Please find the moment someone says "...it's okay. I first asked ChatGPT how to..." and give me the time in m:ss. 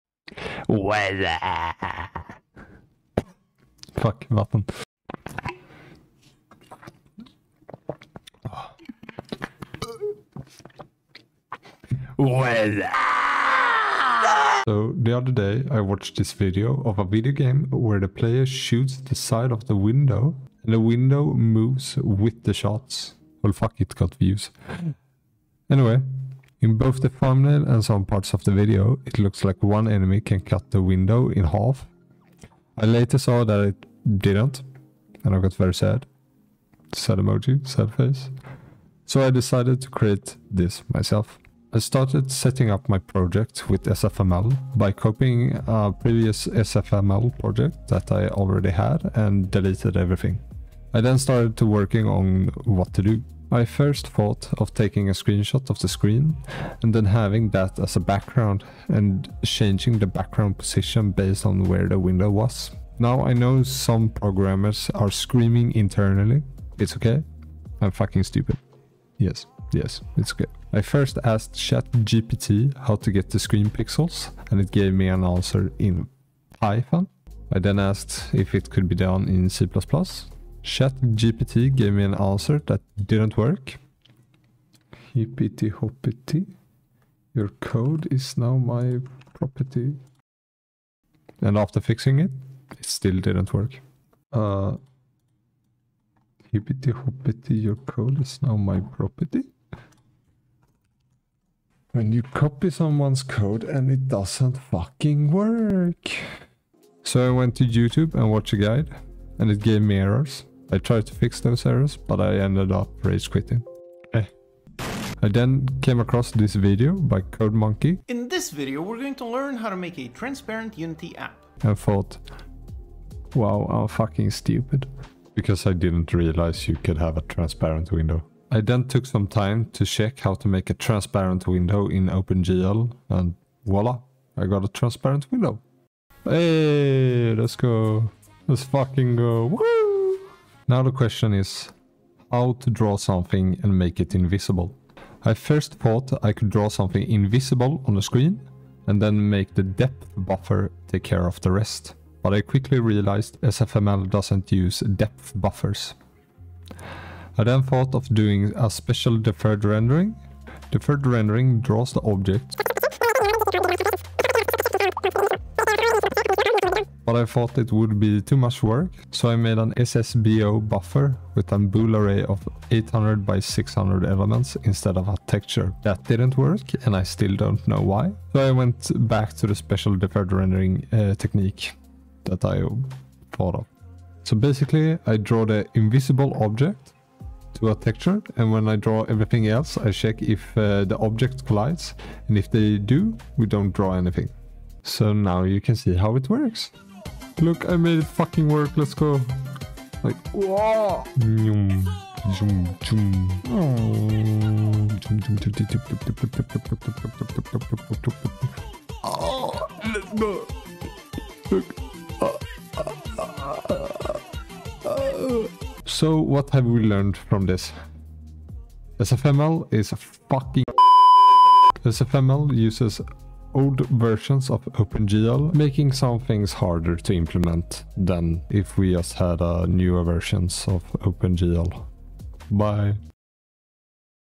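1:10.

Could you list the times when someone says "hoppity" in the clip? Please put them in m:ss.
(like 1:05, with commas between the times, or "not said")
1:25, 1:36.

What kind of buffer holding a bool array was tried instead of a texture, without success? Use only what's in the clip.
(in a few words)
SSBO.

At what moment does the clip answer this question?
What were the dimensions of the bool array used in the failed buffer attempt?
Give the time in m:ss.
2:52.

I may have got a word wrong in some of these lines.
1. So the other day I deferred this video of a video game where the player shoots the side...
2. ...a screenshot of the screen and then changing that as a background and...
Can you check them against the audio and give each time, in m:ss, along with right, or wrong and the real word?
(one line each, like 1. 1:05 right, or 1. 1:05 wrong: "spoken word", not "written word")
1. 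0:14 wrong: "watched", not "deferred"
2. 0:55 wrong: "having", not "changing".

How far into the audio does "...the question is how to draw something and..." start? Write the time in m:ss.
2:20.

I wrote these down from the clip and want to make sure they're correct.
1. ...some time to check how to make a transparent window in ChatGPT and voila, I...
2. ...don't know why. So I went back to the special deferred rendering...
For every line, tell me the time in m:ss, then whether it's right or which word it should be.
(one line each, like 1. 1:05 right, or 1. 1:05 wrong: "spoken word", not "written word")
1. 2:09 wrong: "OpenGL", not "ChatGPT"
2. 2:57 right.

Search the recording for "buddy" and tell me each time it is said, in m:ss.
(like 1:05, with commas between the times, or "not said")
not said.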